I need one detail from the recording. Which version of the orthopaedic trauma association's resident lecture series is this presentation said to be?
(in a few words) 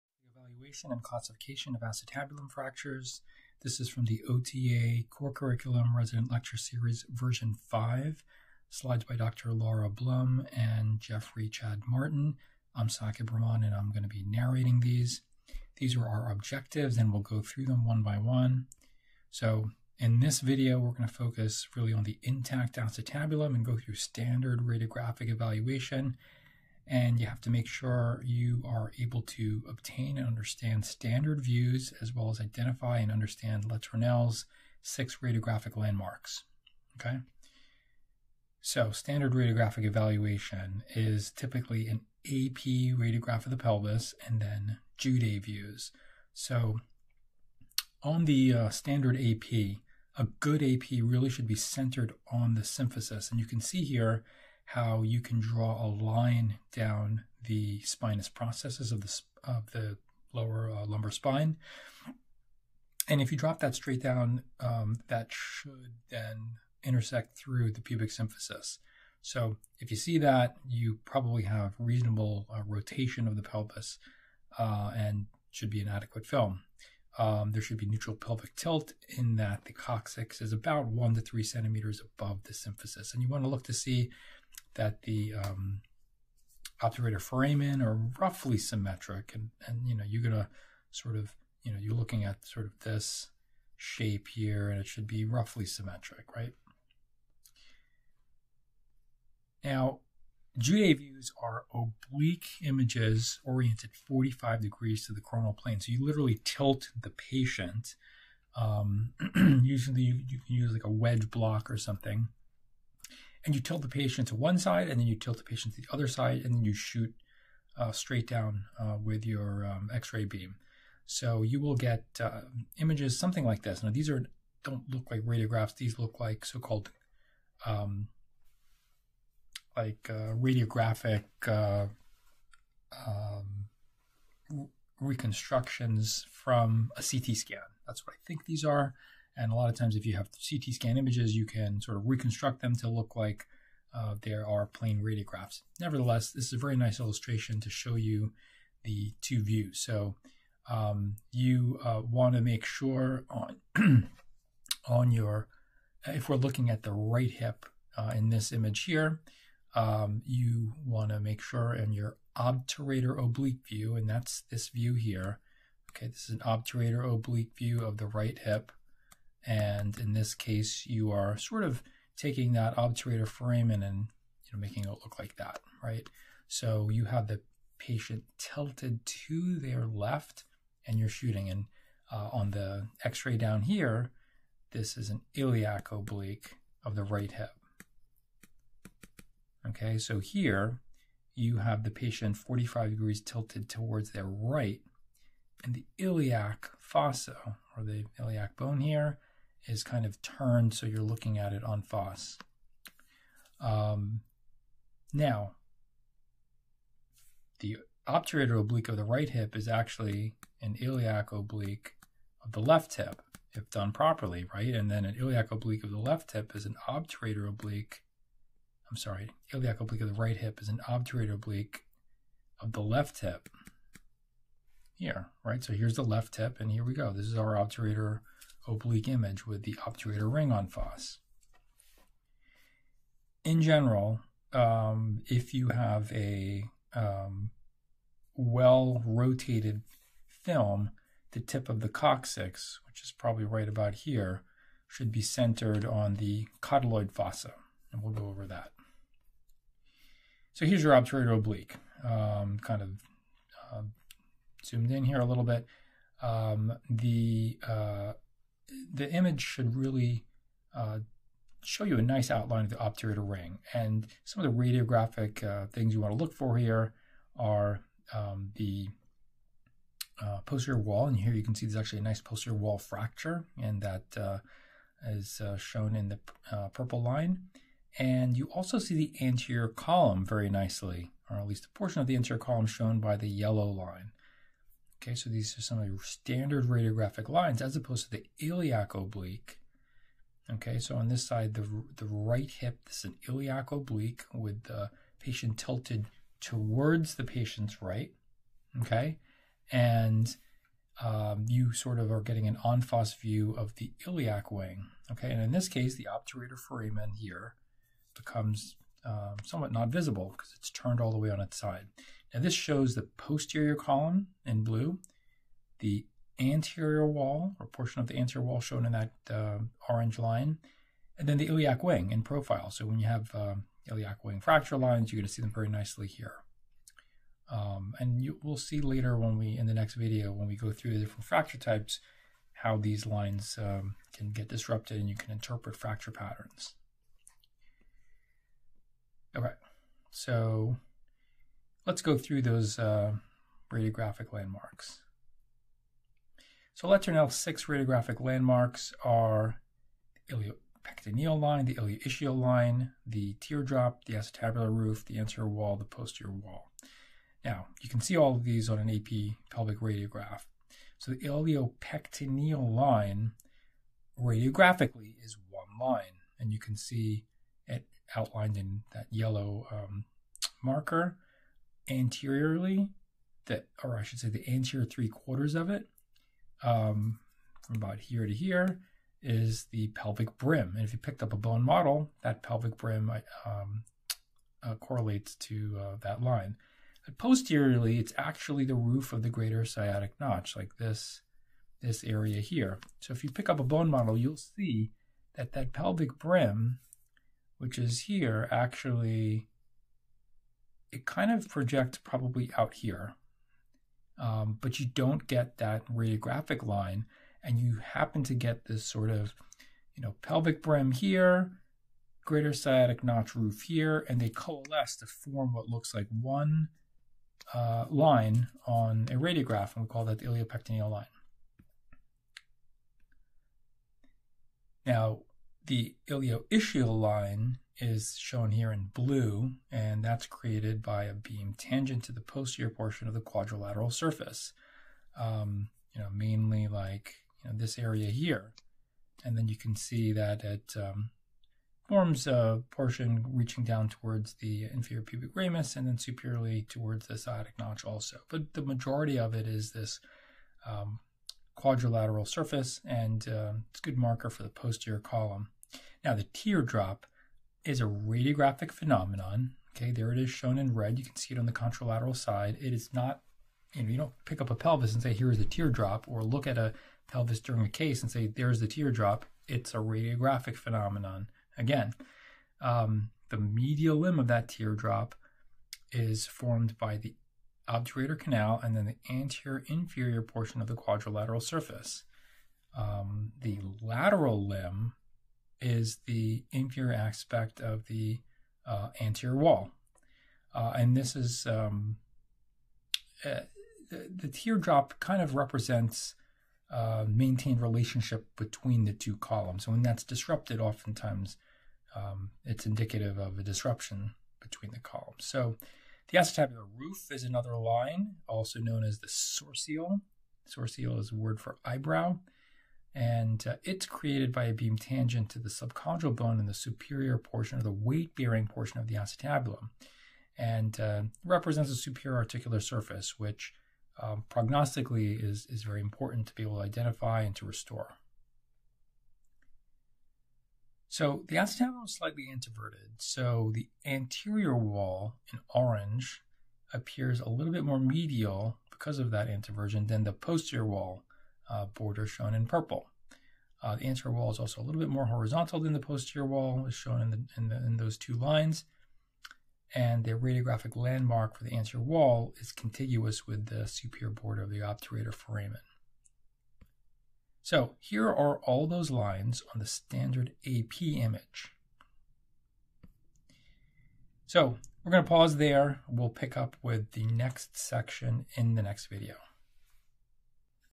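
5.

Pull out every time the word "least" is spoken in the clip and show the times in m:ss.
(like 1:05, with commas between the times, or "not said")
4:41.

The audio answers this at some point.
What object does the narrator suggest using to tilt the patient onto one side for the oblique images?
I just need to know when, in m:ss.
1:50.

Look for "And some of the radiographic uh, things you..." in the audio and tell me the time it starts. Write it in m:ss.
4:23.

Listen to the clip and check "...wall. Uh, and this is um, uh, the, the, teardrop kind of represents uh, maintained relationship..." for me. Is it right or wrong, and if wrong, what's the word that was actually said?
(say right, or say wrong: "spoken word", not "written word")
right.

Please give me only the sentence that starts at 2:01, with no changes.
So you will get uh, images something like this.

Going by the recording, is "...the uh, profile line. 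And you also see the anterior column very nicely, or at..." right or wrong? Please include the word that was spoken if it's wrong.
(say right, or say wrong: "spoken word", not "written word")
wrong: "purple", not "profile".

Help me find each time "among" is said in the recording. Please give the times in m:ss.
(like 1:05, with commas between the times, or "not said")
not said.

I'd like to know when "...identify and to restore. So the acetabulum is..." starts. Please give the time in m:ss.
8:46.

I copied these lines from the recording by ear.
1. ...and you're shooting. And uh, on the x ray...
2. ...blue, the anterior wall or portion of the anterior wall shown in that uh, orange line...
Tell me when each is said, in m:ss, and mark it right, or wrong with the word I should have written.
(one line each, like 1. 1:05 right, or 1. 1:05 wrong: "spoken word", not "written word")
1. 3:00 right
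2. 5:14 right.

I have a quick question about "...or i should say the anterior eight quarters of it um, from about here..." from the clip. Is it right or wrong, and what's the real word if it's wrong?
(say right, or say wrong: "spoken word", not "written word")
wrong: "three", not "eight".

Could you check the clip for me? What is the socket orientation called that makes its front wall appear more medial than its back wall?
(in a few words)
Introversion.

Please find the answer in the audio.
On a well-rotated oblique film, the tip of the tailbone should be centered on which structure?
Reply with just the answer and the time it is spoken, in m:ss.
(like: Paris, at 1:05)
Cotyloid fossa, at 4:06.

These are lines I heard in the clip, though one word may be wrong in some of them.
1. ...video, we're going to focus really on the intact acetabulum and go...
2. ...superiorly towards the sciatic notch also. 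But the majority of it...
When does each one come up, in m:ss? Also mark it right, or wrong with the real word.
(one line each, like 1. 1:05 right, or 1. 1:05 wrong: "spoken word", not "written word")
1. 0:20 right
2. 7:25 right.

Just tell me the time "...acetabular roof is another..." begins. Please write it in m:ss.
8:26.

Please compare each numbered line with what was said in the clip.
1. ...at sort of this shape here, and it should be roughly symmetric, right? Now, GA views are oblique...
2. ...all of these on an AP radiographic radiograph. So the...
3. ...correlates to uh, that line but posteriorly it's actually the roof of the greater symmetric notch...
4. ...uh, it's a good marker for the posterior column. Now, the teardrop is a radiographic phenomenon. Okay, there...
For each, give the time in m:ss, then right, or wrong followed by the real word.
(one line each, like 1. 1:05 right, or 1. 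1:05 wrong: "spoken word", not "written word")
1. 1:32 right
2. 5:58 wrong: "pelvic", not "radiographic"
3. 6:24 wrong: "sciatic", not "symmetric"
4. 7:33 right.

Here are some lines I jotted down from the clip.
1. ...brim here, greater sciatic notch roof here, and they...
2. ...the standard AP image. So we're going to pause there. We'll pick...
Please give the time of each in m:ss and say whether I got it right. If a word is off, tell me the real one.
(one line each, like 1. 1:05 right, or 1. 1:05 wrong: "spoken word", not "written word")
1. 6:50 right
2. 9:19 right.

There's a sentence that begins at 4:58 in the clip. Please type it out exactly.
Okay, and um, you sort of are getting an en-face view of the iliac wing.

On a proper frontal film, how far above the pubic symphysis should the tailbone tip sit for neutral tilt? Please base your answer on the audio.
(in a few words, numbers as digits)
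1 to 3 centimeters.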